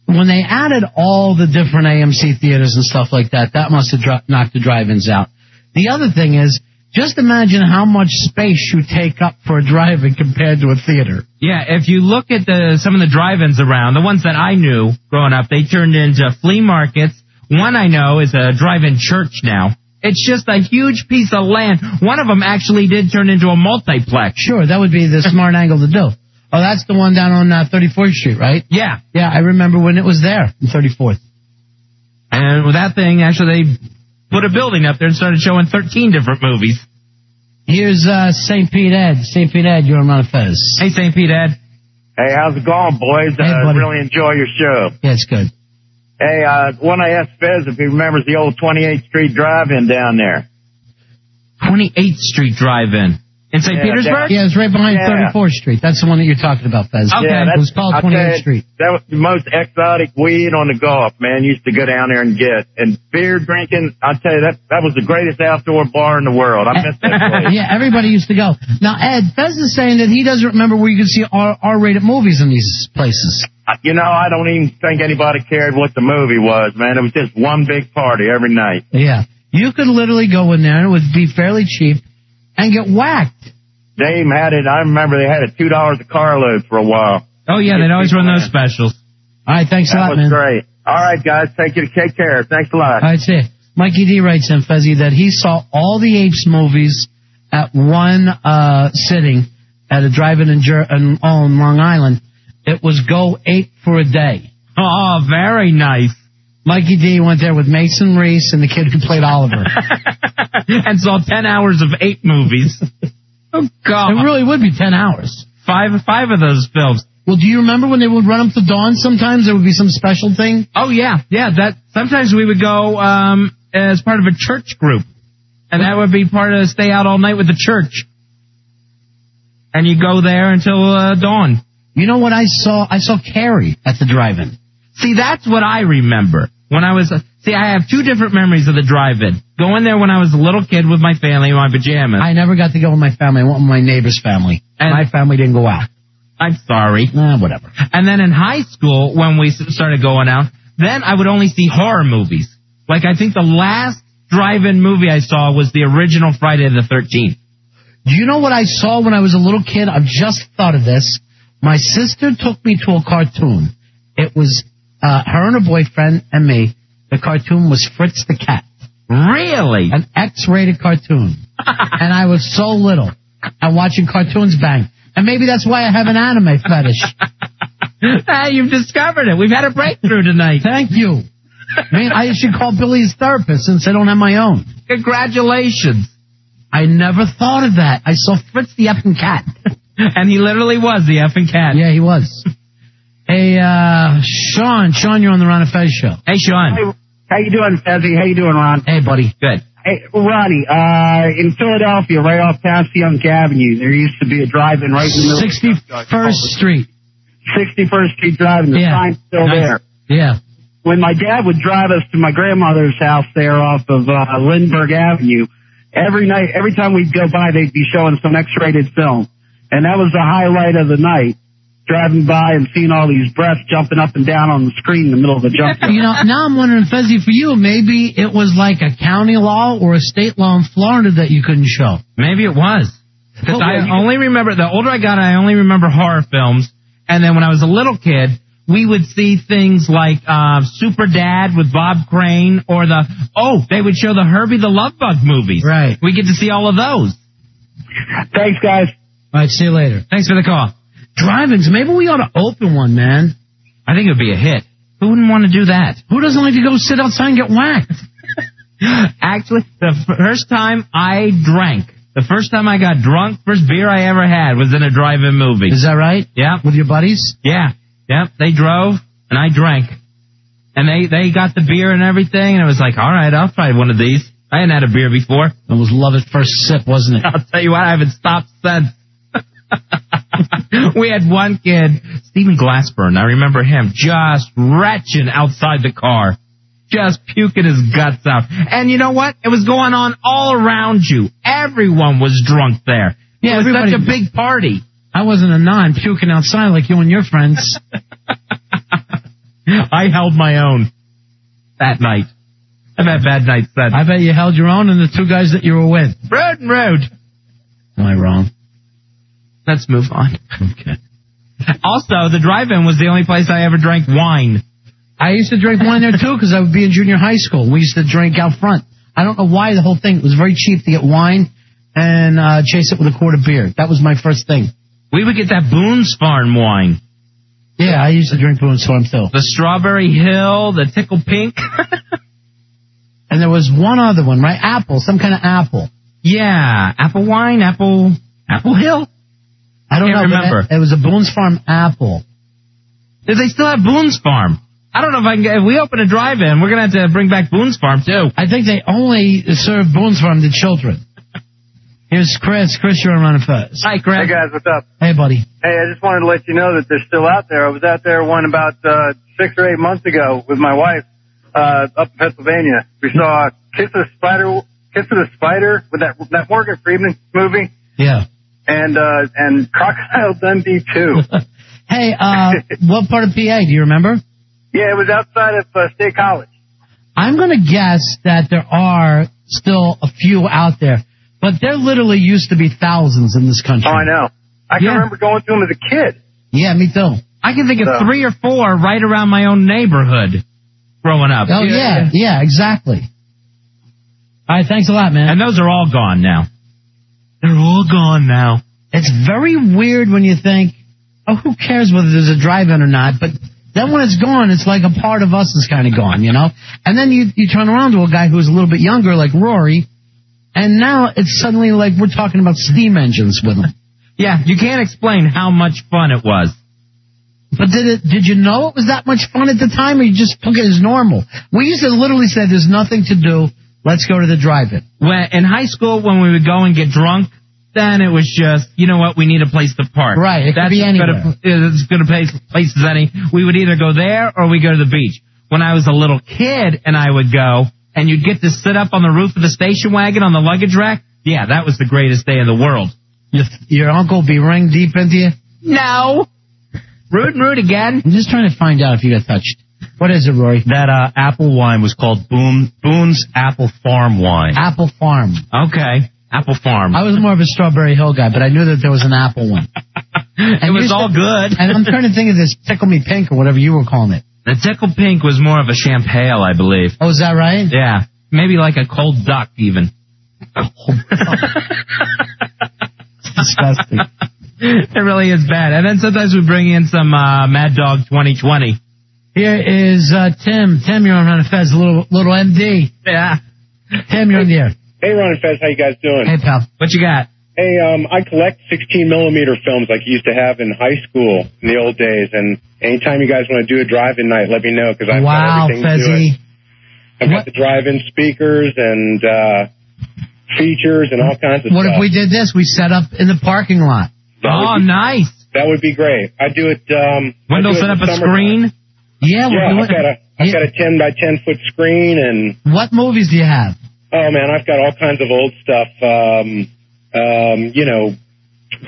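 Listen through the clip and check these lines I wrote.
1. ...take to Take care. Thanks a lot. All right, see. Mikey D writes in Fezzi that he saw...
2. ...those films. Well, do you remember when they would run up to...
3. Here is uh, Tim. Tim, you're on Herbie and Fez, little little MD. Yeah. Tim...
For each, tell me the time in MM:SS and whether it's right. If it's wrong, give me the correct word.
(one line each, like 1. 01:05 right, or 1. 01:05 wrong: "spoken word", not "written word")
1. 01:31 right
2. 01:56 right
3. 07:59 wrong: "Ron", not "Herbie".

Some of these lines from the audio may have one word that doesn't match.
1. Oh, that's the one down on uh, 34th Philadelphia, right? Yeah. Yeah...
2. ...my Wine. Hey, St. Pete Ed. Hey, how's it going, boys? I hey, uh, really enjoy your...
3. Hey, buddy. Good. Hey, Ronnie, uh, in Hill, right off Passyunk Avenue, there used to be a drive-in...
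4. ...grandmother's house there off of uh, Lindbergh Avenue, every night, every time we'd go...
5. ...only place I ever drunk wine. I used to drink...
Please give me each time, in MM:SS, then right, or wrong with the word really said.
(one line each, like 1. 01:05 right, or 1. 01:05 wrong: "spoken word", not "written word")
1. 00:26 wrong: "Street", not "Philadelphia"
2. 00:40 wrong: "Fez", not "Wine"
3. 03:18 wrong: "Philadelphia", not "Hill"
4. 03:32 right
5. 05:13 wrong: "drank", not "drunk".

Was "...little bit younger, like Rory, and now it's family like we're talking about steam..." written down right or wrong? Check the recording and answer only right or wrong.
wrong.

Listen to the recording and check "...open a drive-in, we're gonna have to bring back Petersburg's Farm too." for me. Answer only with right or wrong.
wrong.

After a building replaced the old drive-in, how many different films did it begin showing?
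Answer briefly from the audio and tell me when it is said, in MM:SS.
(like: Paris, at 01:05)
13, at 00:35.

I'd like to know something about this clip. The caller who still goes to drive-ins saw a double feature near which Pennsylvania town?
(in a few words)
State College.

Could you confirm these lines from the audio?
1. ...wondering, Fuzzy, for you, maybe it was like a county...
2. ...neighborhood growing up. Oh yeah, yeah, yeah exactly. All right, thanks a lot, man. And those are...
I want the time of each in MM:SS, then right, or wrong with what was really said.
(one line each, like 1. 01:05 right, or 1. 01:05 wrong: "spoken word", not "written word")
1. 03:46 right
2. 06:29 right.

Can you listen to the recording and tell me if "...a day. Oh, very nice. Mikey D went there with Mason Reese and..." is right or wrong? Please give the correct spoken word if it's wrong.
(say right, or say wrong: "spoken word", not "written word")
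right.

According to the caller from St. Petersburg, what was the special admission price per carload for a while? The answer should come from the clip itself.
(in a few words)
two dollars.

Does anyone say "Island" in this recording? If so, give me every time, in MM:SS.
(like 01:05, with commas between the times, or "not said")
01:41.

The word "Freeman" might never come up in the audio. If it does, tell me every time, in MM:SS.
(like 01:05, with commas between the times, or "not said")
06:06.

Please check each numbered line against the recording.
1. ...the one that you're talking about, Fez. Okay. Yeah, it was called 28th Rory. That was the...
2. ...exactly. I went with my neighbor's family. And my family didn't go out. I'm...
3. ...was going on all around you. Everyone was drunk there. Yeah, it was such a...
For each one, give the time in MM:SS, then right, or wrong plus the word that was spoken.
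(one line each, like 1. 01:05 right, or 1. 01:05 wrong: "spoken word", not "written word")
1. 00:56 wrong: "Street", not "Rory"
2. 02:23 wrong: "family", not "exactly"
3. 04:49 right.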